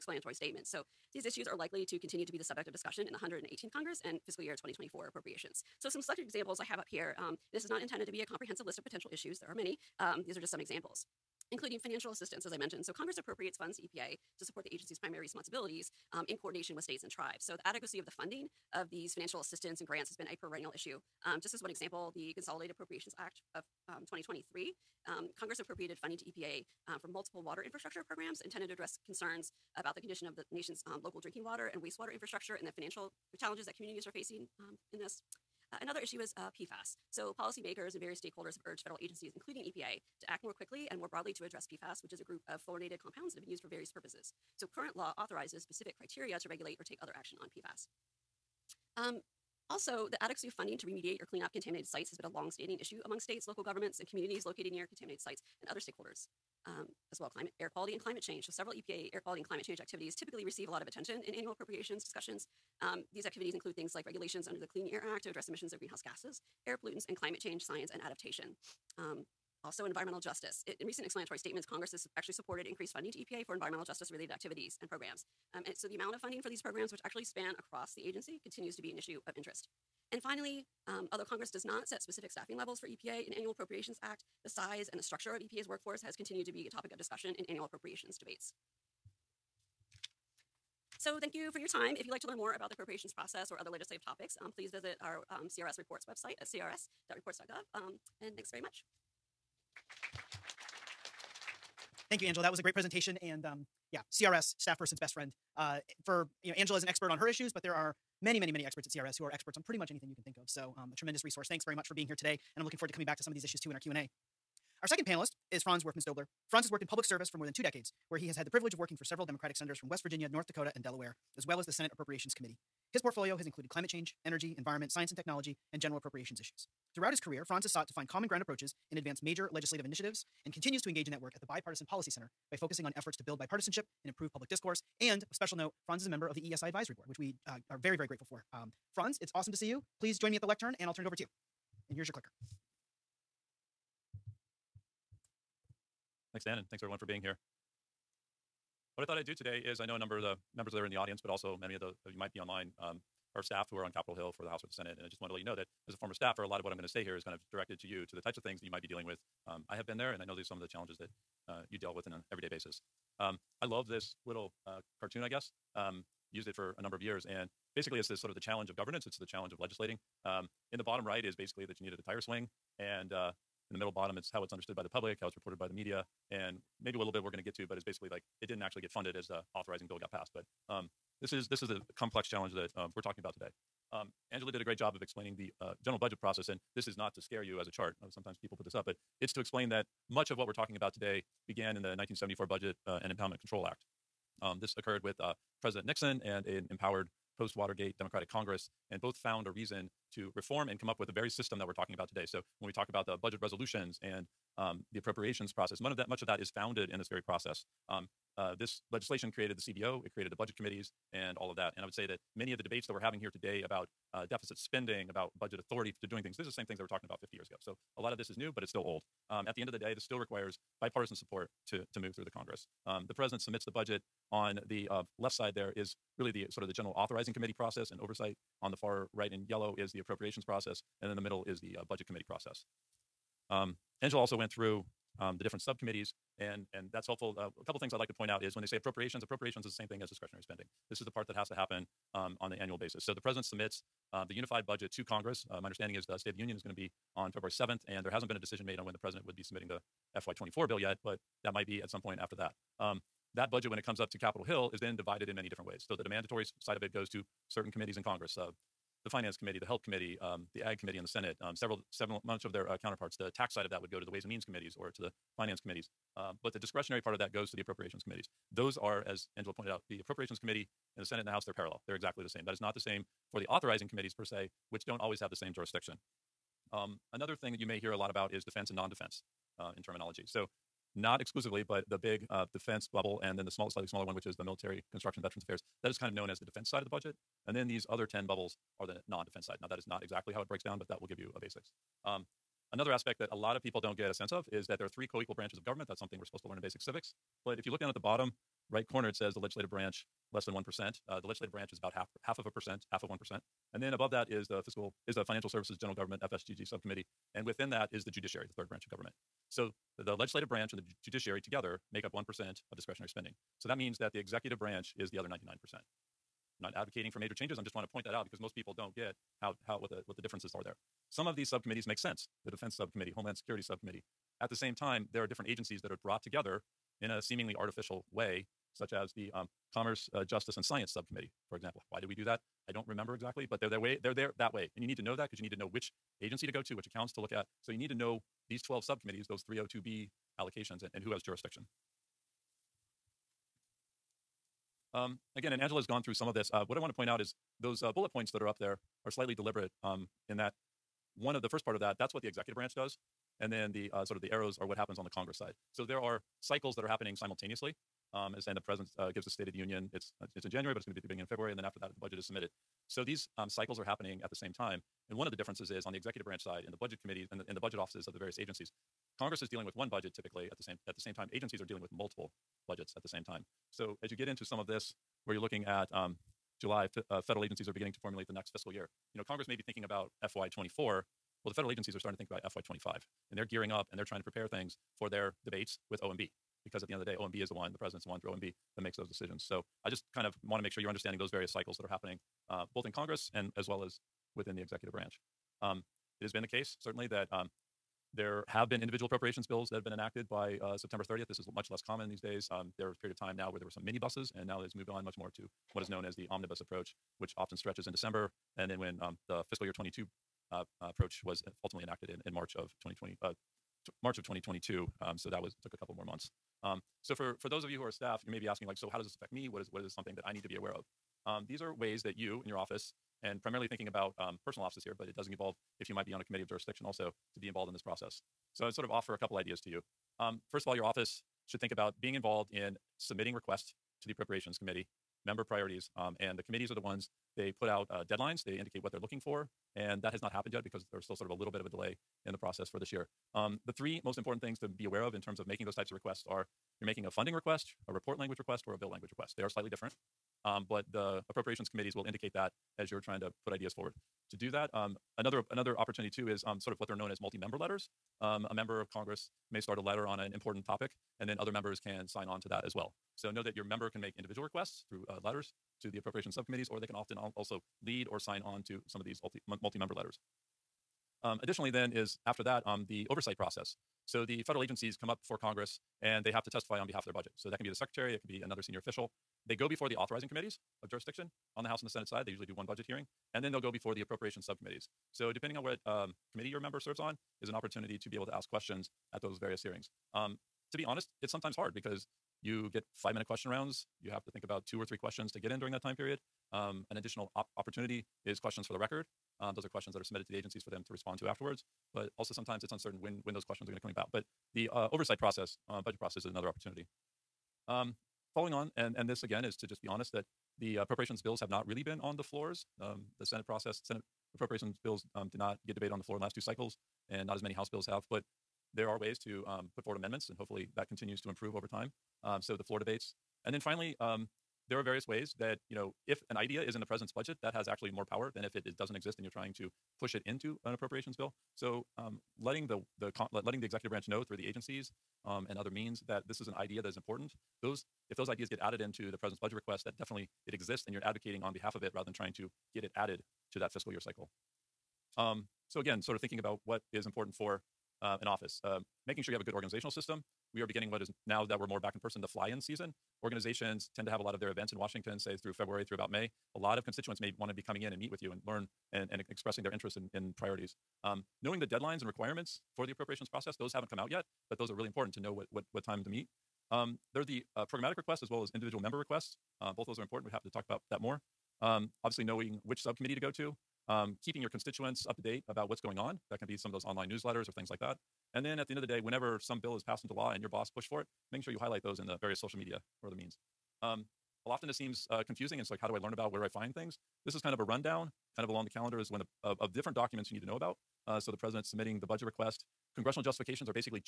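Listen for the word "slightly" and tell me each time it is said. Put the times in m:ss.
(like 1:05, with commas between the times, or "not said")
4:43, 5:49, 7:29.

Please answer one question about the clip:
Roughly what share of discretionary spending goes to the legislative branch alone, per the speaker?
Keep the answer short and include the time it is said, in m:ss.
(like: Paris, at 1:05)
half of 1%, at 5:02.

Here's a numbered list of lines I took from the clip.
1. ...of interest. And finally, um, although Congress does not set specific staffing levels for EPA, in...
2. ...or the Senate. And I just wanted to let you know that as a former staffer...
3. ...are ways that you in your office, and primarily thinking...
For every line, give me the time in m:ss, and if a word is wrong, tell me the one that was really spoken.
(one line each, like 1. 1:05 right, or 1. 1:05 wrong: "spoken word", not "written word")
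1. 1:19 right
2. 2:34 right
3. 7:01 right.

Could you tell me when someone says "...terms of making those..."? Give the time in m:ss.
7:25.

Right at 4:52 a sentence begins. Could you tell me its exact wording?
Um, another aspect that a lot of people don't get a sense of is that there are three co-equal branches of government.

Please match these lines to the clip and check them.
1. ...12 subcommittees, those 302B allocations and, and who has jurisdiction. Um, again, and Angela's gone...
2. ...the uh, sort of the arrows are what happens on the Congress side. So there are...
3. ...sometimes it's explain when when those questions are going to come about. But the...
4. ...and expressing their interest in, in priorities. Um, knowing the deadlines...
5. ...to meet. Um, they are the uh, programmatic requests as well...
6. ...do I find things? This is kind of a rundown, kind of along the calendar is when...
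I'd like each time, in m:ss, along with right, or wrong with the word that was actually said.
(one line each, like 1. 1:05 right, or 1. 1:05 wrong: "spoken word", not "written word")
1. 5:38 right
2. 5:53 right
3. 8:22 wrong: "uncertain", not "explain"
4. 9:19 right
5. 9:26 right
6. 9:46 right.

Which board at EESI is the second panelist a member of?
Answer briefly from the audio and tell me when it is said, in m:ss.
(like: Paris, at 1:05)
Advisory Board, at 2:16.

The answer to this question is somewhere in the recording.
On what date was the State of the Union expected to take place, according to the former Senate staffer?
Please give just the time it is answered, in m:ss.
4:07.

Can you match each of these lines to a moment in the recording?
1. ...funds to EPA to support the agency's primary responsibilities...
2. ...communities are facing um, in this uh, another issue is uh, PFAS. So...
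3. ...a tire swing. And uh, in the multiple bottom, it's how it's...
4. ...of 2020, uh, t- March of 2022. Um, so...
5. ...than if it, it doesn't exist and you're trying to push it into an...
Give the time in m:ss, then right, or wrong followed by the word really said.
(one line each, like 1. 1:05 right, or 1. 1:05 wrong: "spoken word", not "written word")
1. 0:13 right
2. 0:33 right
3. 2:51 wrong: "middle", not "multiple"
4. 6:52 right
5. 8:48 right.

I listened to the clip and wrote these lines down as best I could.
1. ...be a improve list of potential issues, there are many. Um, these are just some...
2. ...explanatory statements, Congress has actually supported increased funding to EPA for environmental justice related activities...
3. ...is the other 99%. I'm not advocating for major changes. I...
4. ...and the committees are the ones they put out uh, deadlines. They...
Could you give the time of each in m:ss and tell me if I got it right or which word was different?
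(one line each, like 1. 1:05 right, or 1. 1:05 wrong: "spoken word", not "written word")
1. 0:08 wrong: "comprehensive", not "improve"
2. 1:11 right
3. 5:14 right
4. 7:16 right.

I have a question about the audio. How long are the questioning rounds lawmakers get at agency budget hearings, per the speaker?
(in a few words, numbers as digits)
5 minutes.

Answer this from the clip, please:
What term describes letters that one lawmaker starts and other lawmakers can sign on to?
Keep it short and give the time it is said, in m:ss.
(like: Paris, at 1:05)
multi-member letters, at 7:37.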